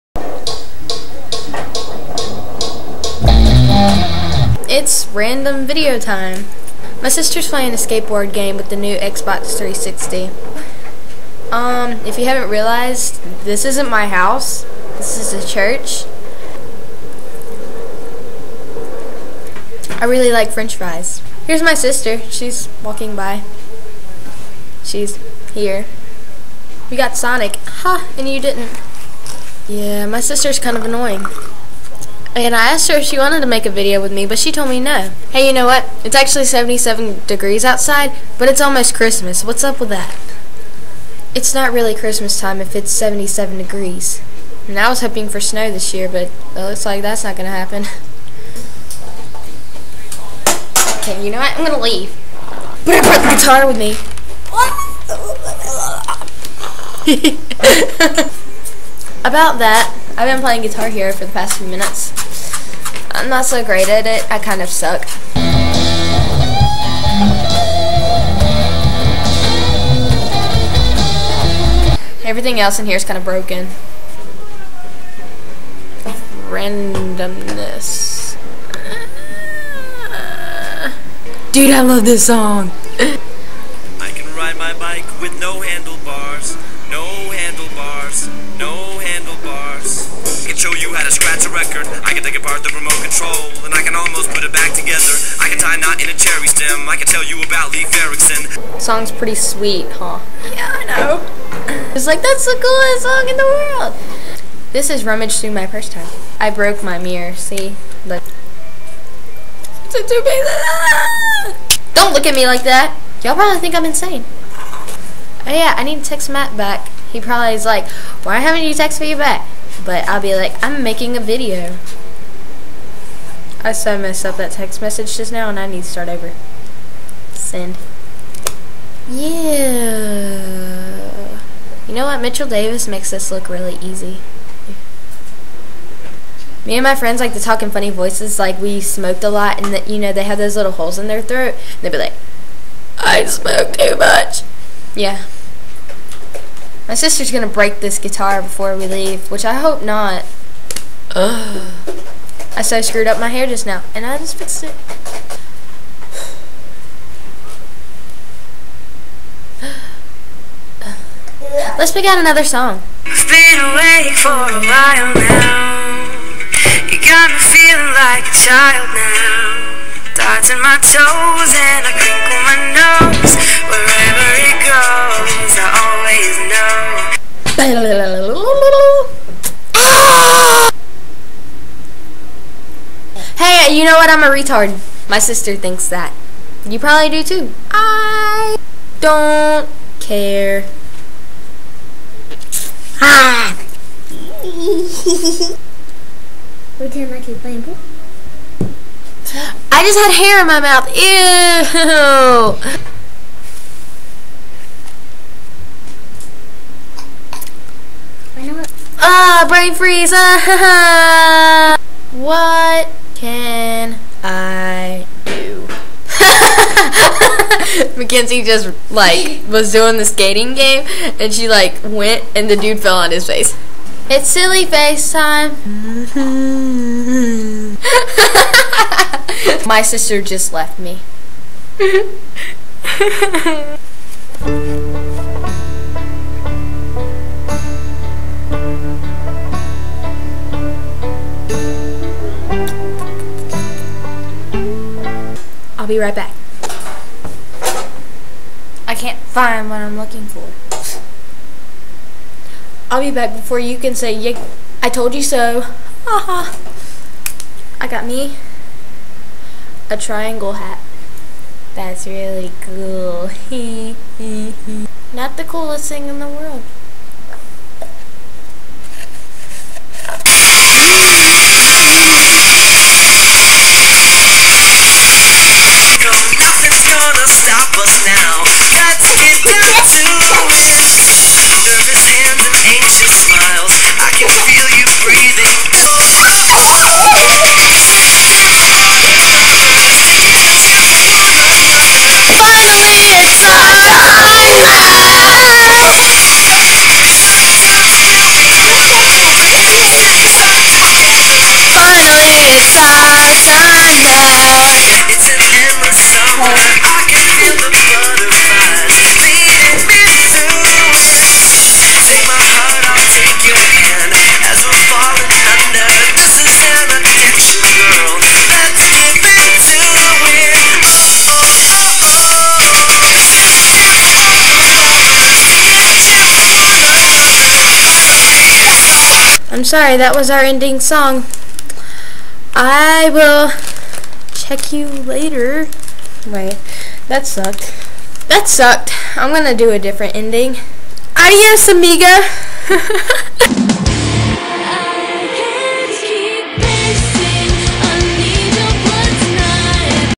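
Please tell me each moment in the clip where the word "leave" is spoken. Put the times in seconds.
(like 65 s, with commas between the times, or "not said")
51 s, 148 s.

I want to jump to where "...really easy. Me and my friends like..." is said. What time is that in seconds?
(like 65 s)
133 s.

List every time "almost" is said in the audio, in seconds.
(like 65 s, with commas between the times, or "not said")
38 s, 93 s.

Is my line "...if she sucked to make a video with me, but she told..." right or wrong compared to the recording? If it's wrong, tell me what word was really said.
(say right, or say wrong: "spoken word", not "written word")
wrong: "wanted", not "sucked".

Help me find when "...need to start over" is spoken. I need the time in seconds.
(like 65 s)
125 s.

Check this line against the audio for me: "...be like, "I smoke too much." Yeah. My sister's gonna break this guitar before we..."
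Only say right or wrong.
right.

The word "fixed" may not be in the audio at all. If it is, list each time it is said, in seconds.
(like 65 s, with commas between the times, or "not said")
154 s.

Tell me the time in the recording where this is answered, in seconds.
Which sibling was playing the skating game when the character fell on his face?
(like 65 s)
217 s.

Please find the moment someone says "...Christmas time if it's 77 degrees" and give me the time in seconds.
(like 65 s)
41 s.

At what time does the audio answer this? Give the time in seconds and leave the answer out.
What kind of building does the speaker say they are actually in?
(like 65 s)
15 s.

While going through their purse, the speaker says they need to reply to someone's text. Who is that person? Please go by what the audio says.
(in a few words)
Matt.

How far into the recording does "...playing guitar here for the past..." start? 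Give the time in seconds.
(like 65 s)
60 s.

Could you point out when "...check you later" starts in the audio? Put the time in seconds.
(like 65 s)
334 s.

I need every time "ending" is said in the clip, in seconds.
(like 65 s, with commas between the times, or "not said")
330 s, 340 s.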